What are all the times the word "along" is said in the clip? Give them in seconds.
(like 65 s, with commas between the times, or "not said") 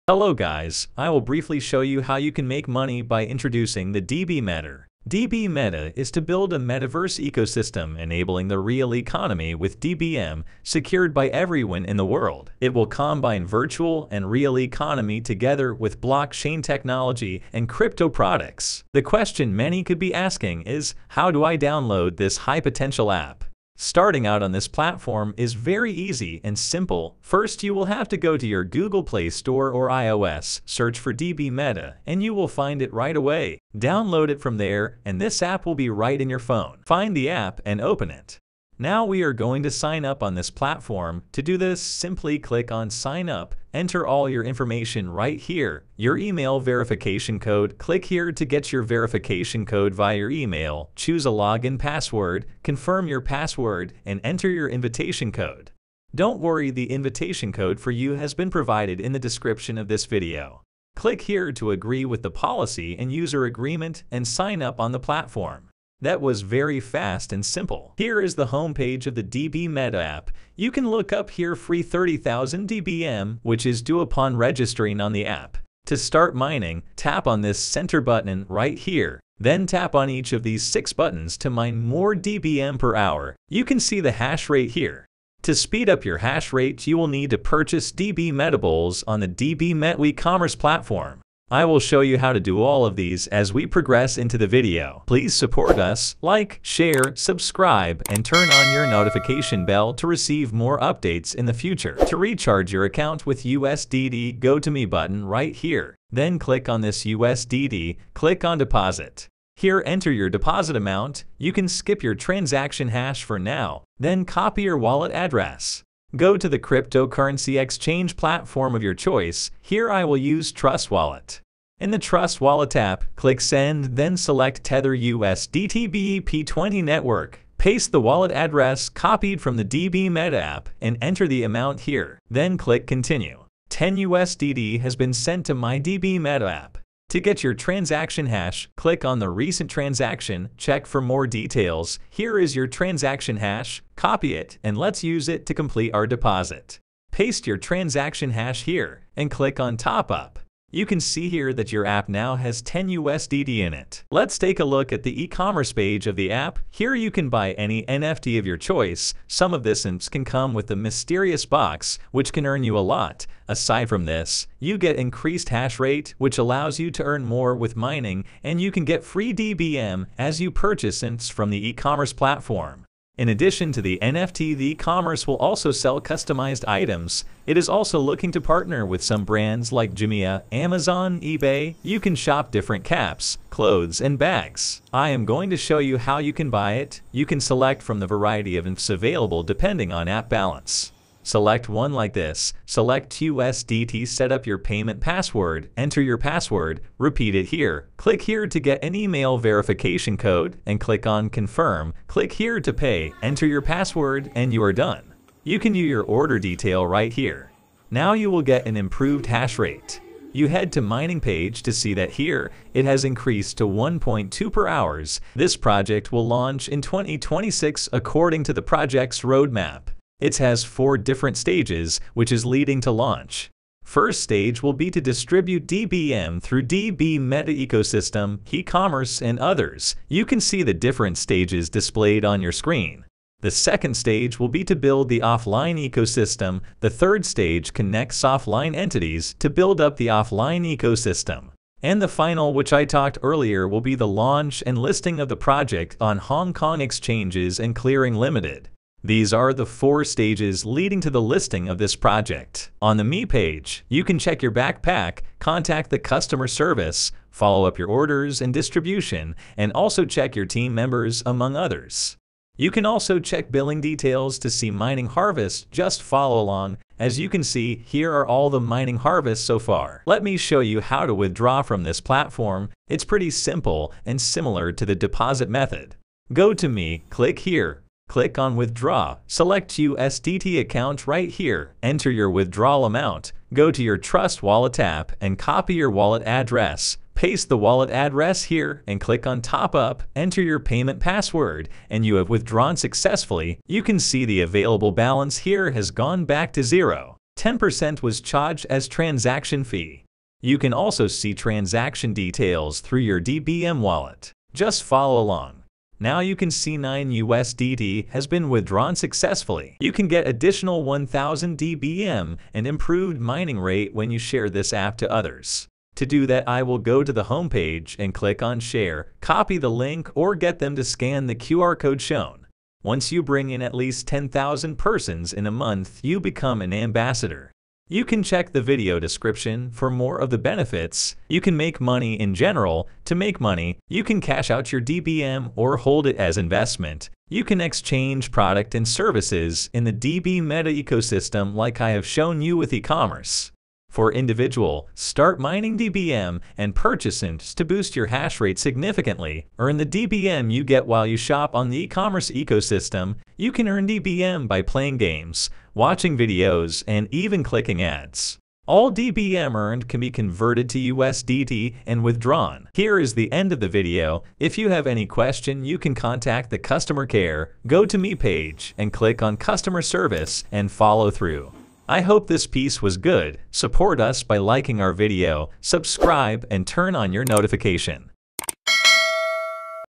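266 s, 305 s.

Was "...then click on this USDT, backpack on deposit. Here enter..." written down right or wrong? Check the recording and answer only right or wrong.
wrong.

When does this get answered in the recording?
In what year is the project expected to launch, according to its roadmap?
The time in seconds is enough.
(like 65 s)
216 s.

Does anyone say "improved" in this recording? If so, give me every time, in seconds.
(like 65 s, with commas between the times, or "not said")
208 s, 312 s.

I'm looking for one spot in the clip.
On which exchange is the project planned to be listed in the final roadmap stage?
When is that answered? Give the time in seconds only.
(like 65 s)
246 s.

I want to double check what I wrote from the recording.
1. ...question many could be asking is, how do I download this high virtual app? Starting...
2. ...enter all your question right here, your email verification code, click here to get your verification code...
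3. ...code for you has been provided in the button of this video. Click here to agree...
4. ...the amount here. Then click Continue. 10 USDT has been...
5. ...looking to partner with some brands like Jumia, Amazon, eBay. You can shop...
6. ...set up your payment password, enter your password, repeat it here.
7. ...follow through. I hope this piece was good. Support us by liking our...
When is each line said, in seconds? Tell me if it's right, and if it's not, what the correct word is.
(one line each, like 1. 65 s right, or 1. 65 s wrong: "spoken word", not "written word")
1. 19 s wrong: "potential", not "virtual"
2. 43 s wrong: "information", not "question"
3. 57 s wrong: "description", not "button"
4. 131 s right
5. 177 s right
6. 194 s right
7. 370 s right.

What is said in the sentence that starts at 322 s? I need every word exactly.
Once you bring in at least 10,000 persons in a month, you become an ambassador.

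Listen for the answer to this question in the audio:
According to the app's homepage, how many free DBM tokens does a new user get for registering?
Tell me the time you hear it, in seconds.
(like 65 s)
71 s.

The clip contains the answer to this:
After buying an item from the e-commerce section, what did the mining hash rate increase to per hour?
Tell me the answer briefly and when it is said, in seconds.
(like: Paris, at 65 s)
1.2, at 213 s.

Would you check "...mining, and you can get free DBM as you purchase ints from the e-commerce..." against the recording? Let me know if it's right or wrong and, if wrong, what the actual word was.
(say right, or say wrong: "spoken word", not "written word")
right.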